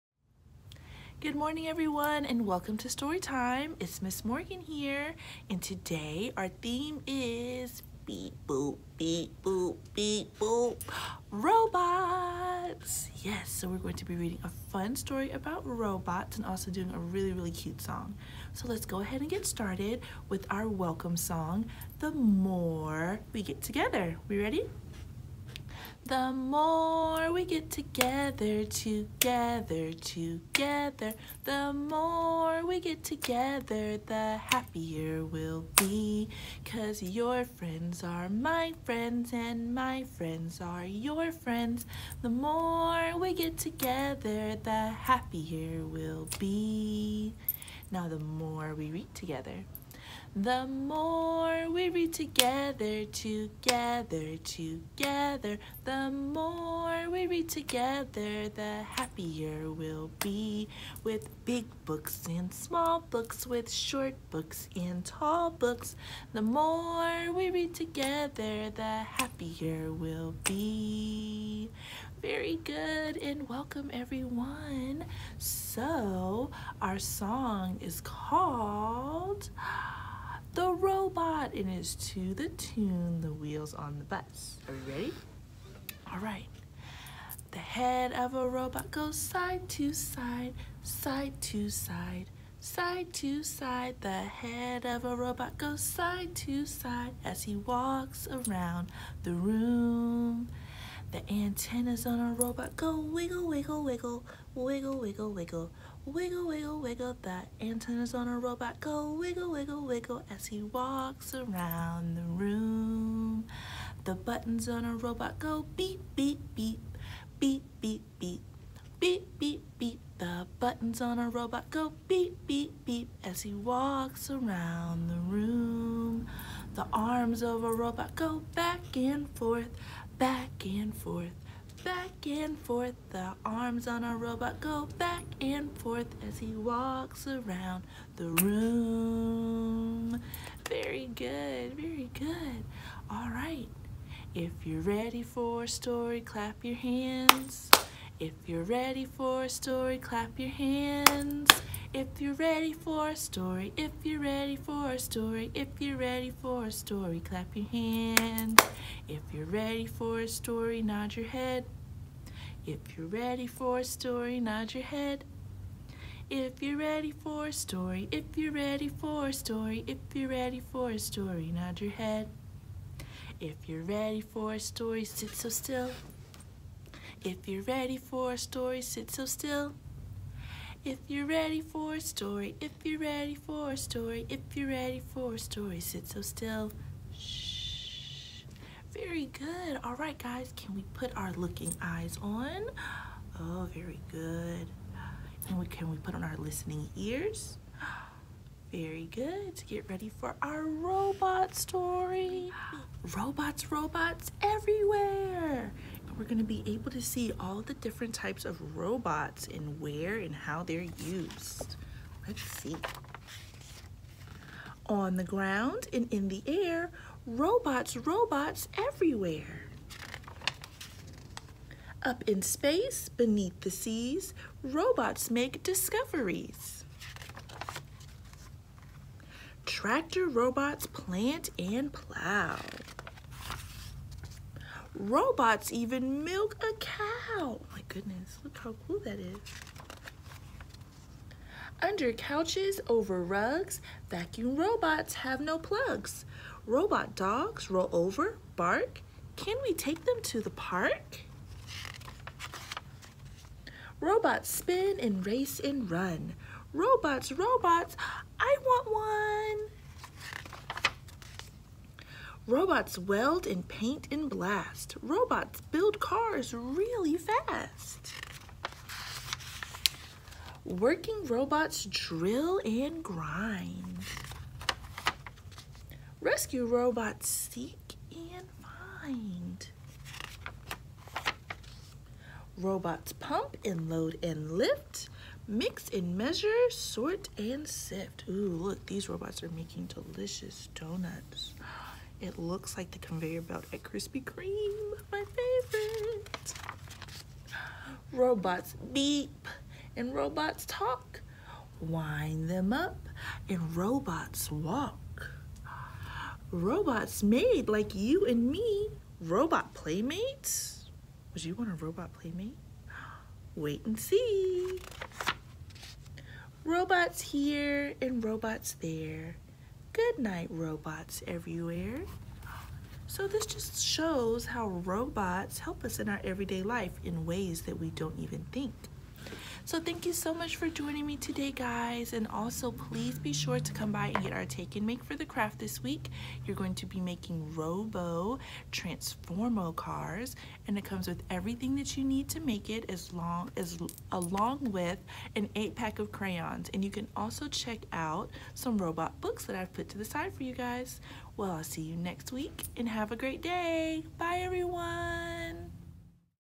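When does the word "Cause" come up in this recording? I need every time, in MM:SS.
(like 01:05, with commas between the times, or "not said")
00:36.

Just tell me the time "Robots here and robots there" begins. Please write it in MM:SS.
05:16.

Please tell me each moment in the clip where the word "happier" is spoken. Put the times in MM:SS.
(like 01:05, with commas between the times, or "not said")
00:34, 00:44, 00:58, 01:09.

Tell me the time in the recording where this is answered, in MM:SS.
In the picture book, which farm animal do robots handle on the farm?
03:56.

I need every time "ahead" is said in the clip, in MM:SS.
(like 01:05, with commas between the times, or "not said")
00:19.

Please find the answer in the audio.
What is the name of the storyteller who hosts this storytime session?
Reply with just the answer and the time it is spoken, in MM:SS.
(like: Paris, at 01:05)
Miss Morgan, at 00:04.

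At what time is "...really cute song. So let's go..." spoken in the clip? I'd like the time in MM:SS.
00:17.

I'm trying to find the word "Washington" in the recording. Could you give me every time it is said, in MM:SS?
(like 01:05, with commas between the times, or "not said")
not said.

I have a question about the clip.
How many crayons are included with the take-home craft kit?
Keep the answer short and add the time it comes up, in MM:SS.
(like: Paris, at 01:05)
8, at 05:45.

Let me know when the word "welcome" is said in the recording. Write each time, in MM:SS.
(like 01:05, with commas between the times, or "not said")
00:02, 00:20, 01:13.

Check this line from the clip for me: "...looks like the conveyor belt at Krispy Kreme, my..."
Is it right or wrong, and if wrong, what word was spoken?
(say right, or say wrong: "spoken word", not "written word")
right.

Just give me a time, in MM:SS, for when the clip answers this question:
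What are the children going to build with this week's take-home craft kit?
05:37.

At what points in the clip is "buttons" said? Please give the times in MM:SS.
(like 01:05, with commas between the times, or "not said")
01:54, 02:00.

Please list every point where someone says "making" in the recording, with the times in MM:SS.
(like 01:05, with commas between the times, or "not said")
04:49, 05:36.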